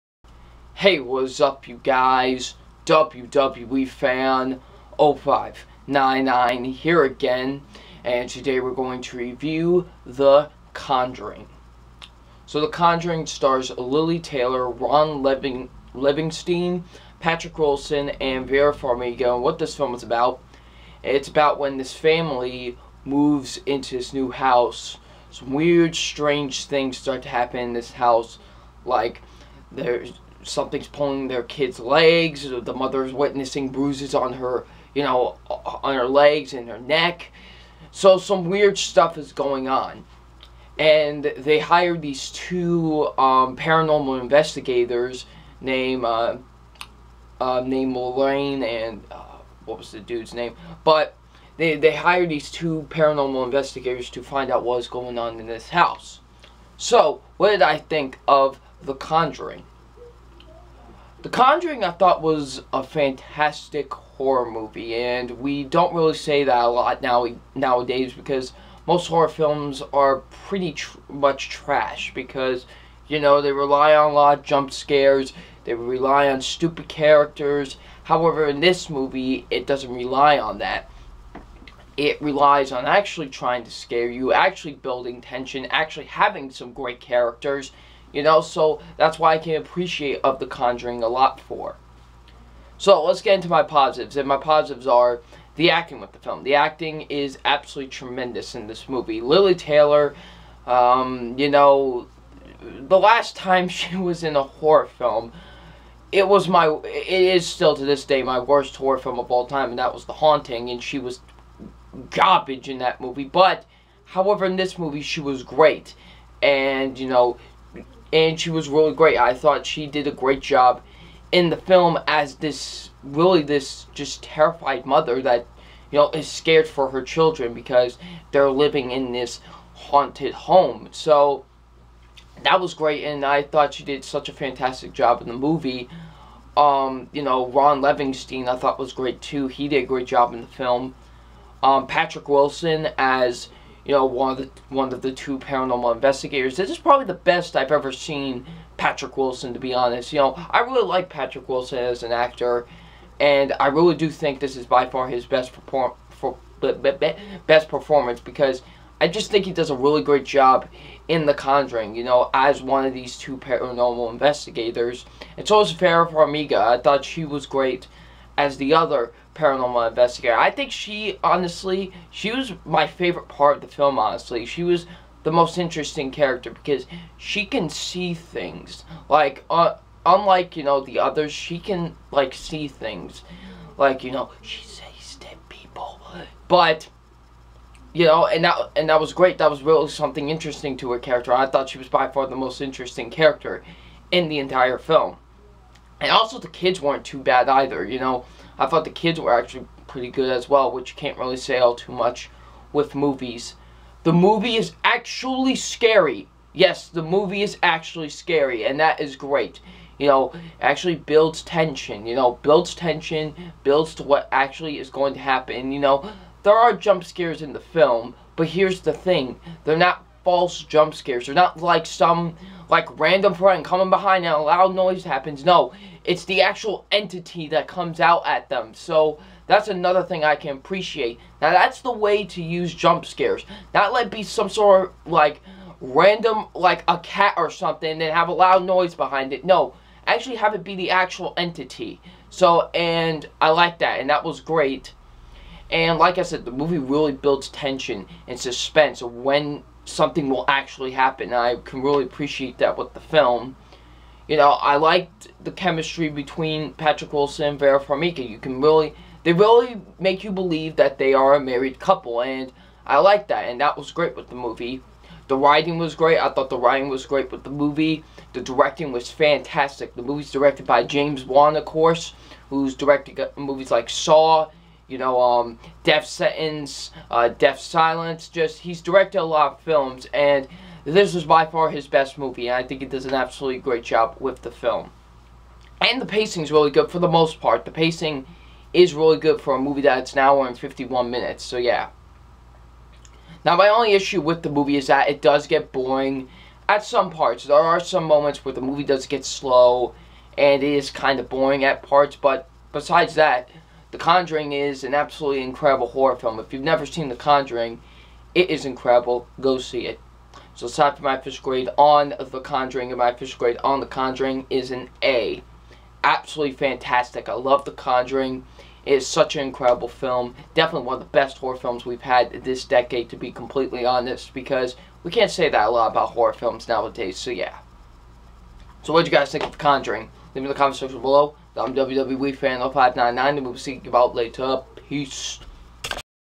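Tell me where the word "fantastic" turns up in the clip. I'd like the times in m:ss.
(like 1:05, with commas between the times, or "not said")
1:02, 2:14, 4:29, 5:16.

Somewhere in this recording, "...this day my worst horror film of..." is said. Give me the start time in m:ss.
1:47.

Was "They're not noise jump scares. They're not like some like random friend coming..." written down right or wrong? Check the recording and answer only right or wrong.
wrong.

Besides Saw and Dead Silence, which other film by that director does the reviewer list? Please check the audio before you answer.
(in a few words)
Death Sentence.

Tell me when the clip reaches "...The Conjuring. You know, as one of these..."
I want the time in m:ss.
2:41.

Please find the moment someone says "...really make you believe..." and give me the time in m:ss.
4:19.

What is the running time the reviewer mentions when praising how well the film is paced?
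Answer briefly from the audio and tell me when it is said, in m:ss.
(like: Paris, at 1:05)
1 hour 51 minutes, at 4:50.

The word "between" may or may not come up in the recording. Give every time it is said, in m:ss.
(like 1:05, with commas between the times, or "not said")
4:16.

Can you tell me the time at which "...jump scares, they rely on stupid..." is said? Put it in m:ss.
1:14.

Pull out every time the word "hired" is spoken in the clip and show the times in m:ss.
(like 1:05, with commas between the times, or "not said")
0:41, 0:51.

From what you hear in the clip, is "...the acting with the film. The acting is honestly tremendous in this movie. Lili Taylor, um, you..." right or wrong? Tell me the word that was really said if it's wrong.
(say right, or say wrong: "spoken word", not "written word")
wrong: "absolutely", not "honestly".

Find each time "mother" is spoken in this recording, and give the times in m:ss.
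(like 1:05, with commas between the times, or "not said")
0:32, 2:04.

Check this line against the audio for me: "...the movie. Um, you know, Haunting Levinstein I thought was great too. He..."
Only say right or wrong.
wrong.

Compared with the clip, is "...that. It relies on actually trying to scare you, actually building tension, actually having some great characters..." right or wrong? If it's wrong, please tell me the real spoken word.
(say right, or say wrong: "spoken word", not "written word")
right.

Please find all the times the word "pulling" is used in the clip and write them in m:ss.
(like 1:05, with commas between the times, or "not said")
0:30.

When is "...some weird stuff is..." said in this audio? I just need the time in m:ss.
0:38.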